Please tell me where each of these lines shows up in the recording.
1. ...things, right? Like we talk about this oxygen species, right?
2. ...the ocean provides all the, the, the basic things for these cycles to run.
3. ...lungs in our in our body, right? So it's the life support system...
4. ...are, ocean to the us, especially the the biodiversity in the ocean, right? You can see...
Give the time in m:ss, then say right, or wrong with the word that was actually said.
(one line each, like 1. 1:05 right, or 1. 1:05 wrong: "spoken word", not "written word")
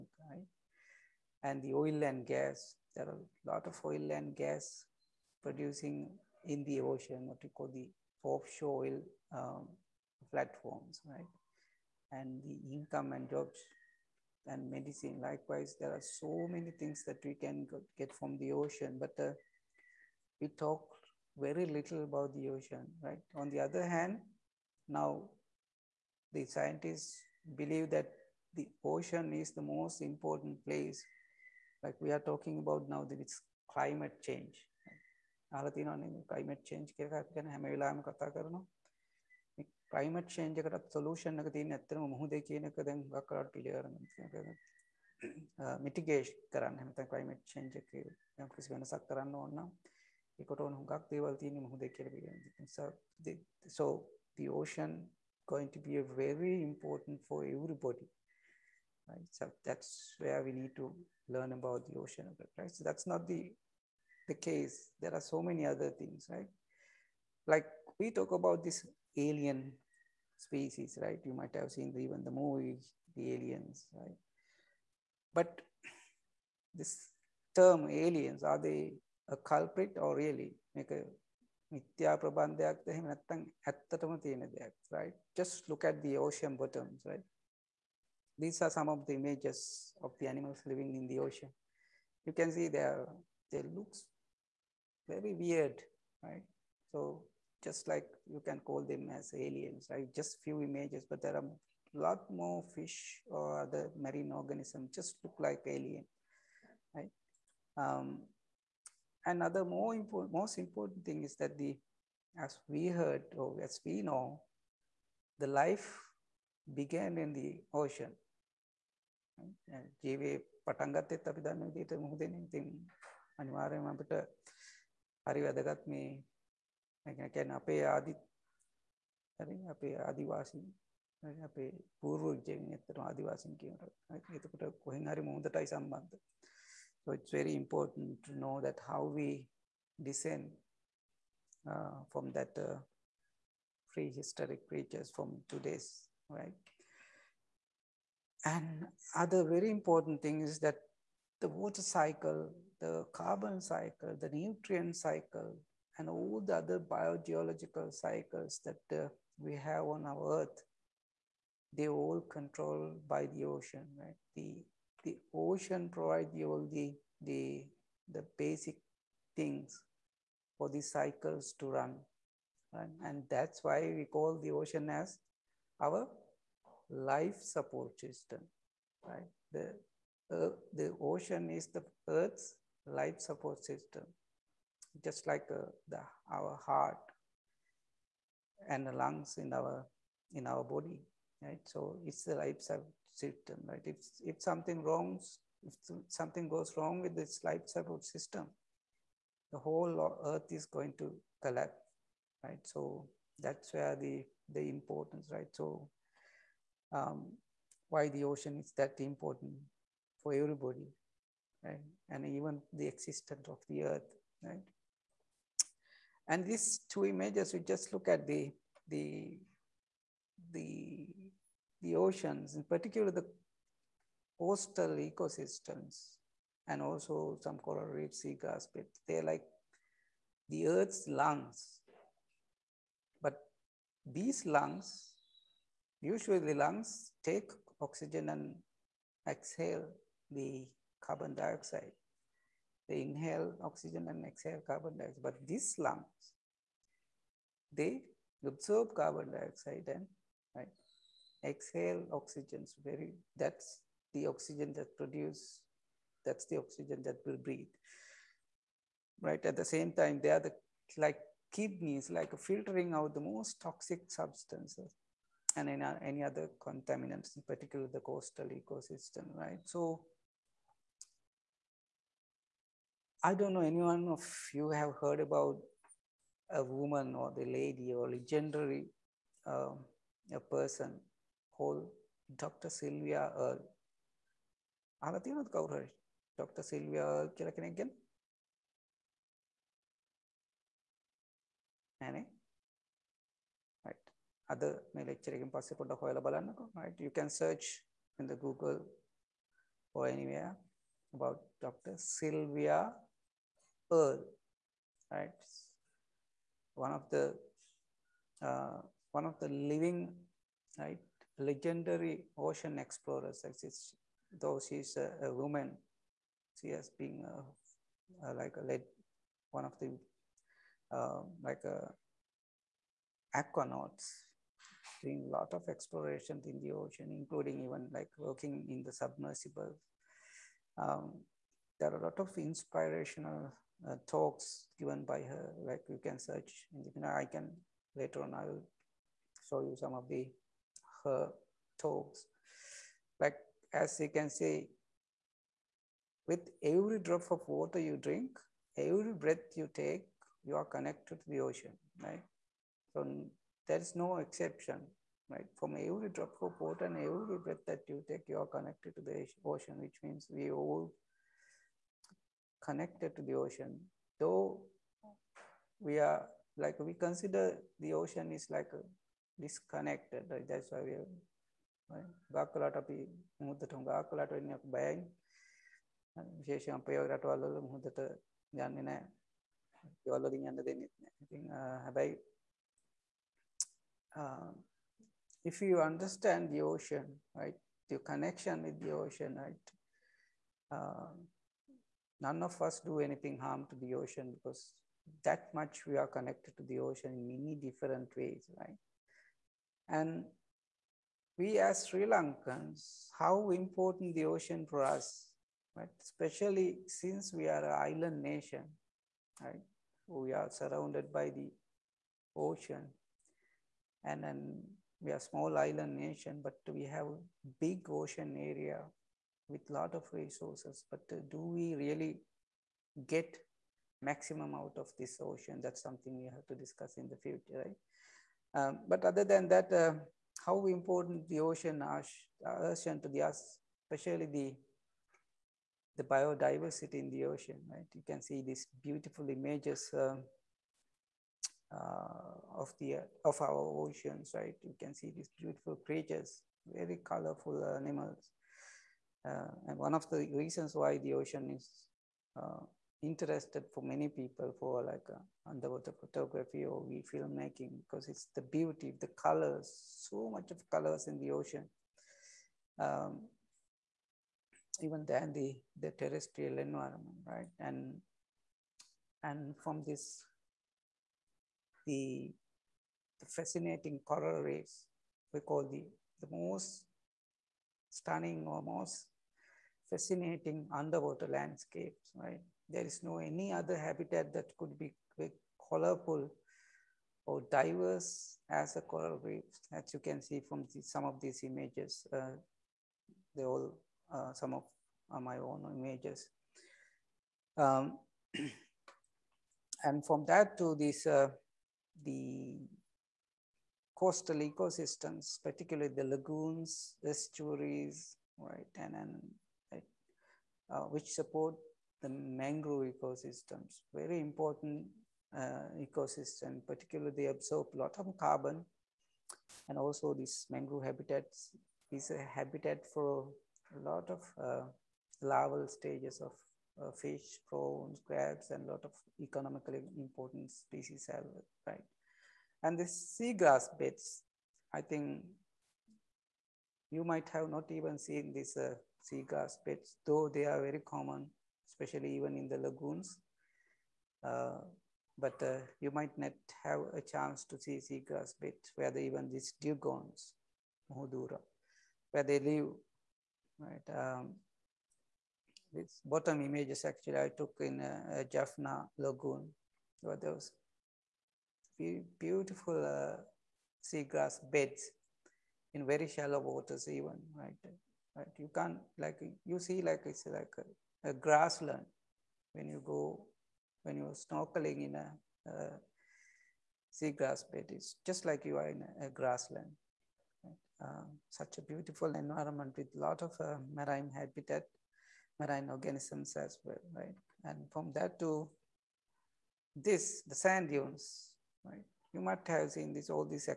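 1. 1:05 wrong: "alien", not "oxygen"
2. 2:45 right
3. 3:08 right
4. 7:11 right.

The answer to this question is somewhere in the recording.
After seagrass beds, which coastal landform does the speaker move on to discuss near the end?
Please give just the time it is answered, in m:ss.
9:50.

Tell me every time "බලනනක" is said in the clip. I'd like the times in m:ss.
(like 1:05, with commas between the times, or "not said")
4:56.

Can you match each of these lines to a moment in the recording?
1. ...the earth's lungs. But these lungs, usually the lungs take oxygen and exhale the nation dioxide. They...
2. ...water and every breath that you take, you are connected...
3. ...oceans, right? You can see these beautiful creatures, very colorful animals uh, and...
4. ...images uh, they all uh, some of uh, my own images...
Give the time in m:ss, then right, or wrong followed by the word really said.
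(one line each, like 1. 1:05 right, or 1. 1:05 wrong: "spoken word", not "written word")
1. 3:50 wrong: "carbon", not "nation"
2. 5:56 right
3. 7:23 right
4. 8:11 right.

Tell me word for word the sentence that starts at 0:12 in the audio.
And the income and jobs and medicine.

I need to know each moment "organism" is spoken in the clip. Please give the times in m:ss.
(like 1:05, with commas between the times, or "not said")
1:44, 9:45.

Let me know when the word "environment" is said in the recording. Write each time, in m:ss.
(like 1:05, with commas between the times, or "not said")
7:46, 9:42.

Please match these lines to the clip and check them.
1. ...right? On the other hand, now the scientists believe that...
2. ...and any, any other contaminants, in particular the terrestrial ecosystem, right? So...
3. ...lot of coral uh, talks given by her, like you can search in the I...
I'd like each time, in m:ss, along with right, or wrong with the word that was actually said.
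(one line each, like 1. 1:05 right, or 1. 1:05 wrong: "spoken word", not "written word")
1. 0:23 right
2. 4:25 wrong: "coastal", not "terrestrial"
3. 5:32 wrong: "inspirational", not "coral".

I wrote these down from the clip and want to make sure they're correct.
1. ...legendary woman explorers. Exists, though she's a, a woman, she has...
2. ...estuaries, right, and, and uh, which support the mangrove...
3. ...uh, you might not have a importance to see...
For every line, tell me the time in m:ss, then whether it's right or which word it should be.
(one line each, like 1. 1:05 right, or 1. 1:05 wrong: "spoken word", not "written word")
1. 5:11 wrong: "ocean", not "woman"
2. 8:27 right
3. 9:05 wrong: "chance", not "importance".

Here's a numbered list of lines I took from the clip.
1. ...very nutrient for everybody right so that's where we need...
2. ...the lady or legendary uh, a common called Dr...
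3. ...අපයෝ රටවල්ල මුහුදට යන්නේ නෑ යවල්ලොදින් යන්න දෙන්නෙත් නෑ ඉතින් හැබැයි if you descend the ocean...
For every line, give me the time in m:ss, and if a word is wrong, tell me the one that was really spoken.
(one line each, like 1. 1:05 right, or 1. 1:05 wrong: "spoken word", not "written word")
1. 0:56 wrong: "important", not "nutrient"
2. 4:37 wrong: "person", not "common"
3. 6:16 wrong: "understand", not "descend".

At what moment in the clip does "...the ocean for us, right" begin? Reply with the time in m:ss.
6:44.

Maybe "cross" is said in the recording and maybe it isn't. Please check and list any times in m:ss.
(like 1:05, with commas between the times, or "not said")
not said.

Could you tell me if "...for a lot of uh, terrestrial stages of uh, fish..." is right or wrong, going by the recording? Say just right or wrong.
wrong.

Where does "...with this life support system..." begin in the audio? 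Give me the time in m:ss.
3:17.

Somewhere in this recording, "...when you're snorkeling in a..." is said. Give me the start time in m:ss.
9:33.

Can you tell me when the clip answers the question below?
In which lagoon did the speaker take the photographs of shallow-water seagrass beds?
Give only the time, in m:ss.
9:18.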